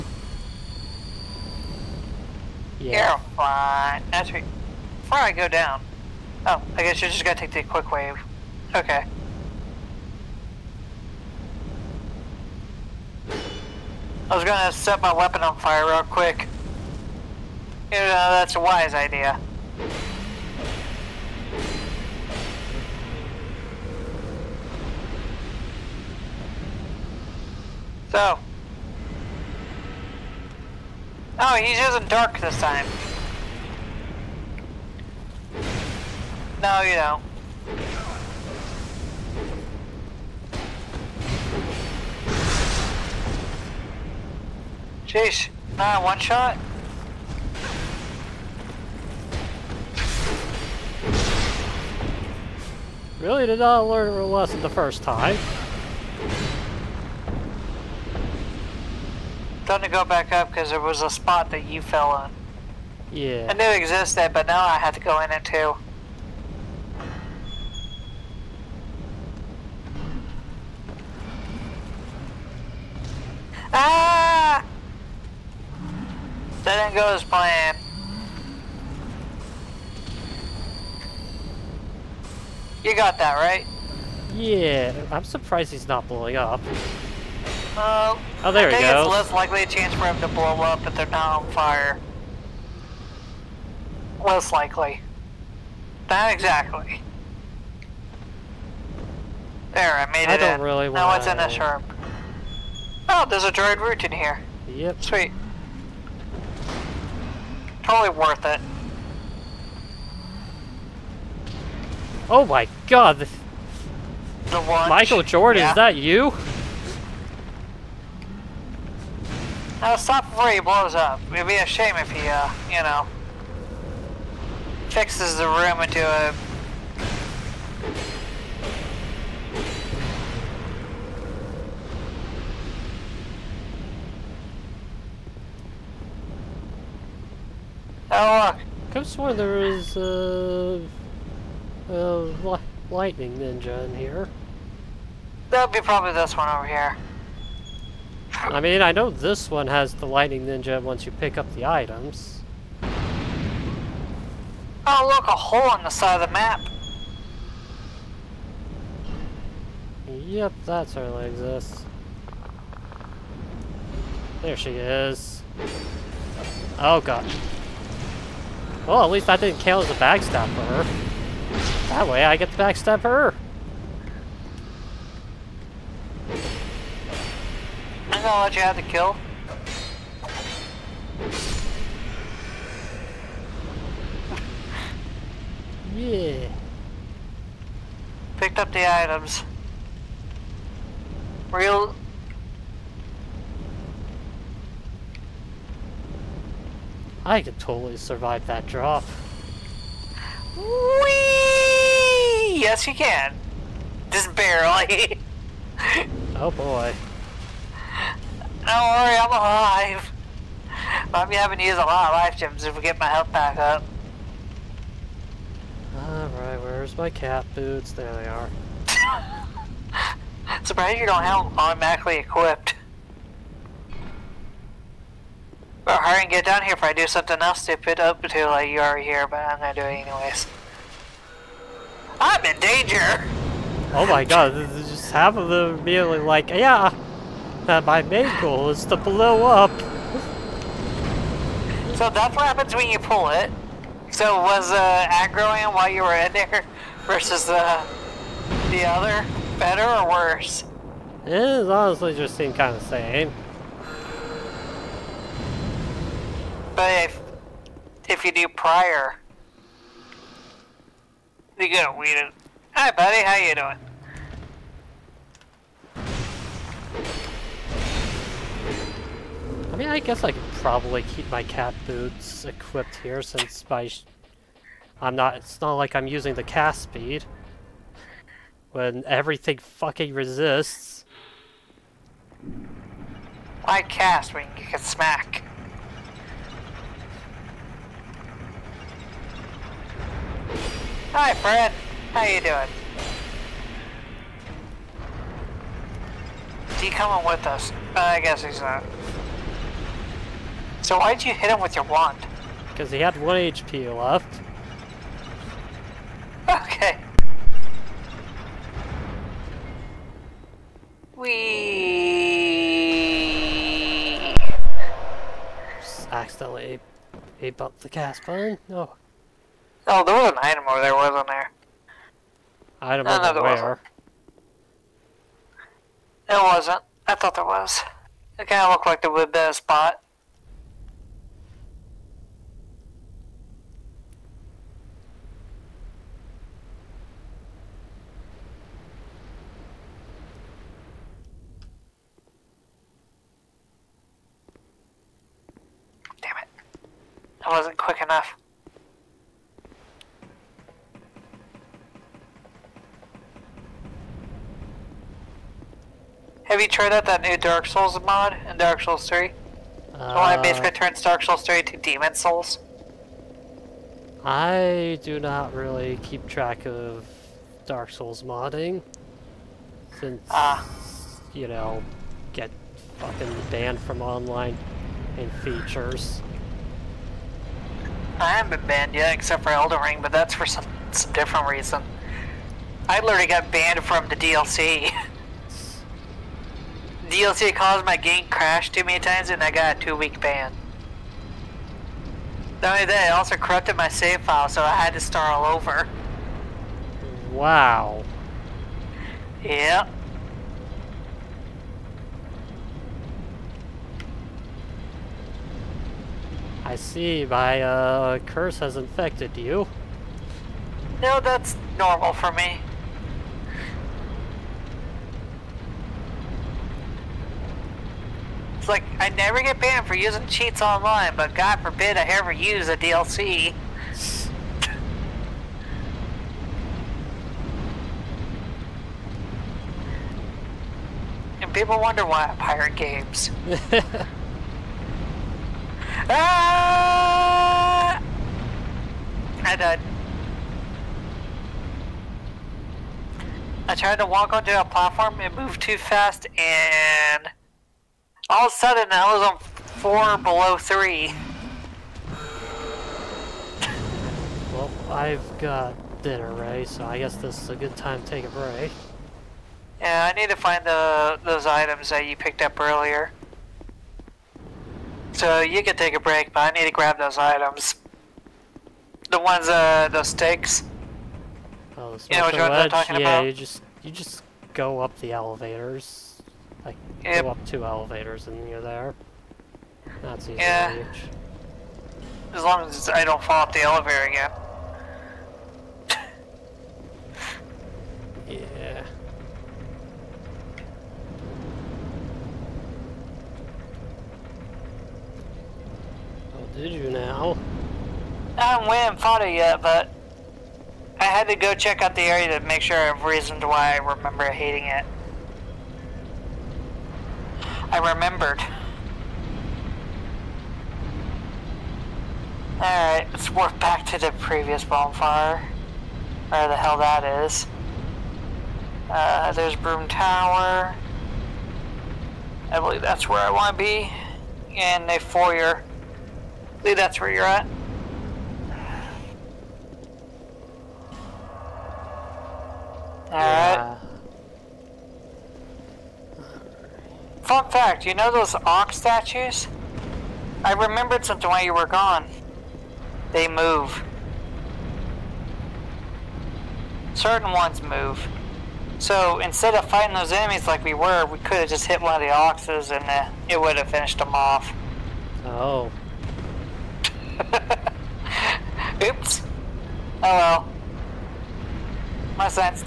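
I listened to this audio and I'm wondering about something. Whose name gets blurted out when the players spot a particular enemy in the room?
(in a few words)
Michael Jordan.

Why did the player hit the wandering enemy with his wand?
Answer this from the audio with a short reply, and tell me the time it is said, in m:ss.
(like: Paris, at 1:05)
He had one HP left, at 5:02.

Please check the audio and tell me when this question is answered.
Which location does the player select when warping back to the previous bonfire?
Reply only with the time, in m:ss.
8:39.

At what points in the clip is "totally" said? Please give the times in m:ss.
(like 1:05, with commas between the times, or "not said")
1:47, 3:17.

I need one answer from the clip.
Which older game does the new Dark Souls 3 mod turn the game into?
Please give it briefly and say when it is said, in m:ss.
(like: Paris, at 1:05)
Demon Souls, at 6:01.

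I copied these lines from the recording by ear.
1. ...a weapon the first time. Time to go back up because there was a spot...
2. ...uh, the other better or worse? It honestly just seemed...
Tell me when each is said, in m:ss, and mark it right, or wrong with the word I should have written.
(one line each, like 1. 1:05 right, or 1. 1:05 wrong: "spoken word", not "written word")
1. 0:54 wrong: "lesson", not "weapon"
2. 4:07 right.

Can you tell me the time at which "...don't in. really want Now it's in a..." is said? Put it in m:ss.
1:40.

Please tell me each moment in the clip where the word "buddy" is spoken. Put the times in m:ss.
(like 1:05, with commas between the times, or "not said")
4:22.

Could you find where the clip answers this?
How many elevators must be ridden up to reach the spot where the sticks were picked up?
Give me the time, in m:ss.
7:57.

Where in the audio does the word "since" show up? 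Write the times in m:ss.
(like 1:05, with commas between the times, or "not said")
4:33, 6:09.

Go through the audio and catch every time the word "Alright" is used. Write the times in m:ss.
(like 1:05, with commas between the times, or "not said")
3:35, 8:32, 8:53.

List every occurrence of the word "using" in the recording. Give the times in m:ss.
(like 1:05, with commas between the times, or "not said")
0:31, 4:36, 6:59.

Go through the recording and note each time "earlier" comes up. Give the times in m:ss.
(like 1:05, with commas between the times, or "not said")
7:42.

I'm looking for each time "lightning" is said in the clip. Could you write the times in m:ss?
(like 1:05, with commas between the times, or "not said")
2:22, 2:30.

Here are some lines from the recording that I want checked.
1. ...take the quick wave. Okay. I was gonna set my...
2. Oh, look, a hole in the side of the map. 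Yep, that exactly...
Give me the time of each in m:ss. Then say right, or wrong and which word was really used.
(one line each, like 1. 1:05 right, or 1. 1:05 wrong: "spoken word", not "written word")
1. 0:07 right
2. 2:34 wrong: "certainly", not "exactly".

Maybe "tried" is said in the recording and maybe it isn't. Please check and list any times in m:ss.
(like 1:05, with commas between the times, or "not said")
5:56, 7:23.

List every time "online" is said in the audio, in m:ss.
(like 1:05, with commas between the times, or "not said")
6:14, 7:00.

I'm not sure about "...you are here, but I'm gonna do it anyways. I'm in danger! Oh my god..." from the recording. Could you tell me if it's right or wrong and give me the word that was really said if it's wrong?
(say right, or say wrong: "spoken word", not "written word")
right.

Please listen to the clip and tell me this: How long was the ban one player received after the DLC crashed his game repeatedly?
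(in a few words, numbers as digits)
2 weeks.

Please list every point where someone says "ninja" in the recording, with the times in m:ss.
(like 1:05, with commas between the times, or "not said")
2:23, 2:30.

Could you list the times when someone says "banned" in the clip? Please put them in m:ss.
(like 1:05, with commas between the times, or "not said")
6:13, 6:18, 6:23, 6:59.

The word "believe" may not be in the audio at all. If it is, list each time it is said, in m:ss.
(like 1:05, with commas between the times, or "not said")
8:42, 8:46.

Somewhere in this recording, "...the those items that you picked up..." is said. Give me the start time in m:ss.
7:40.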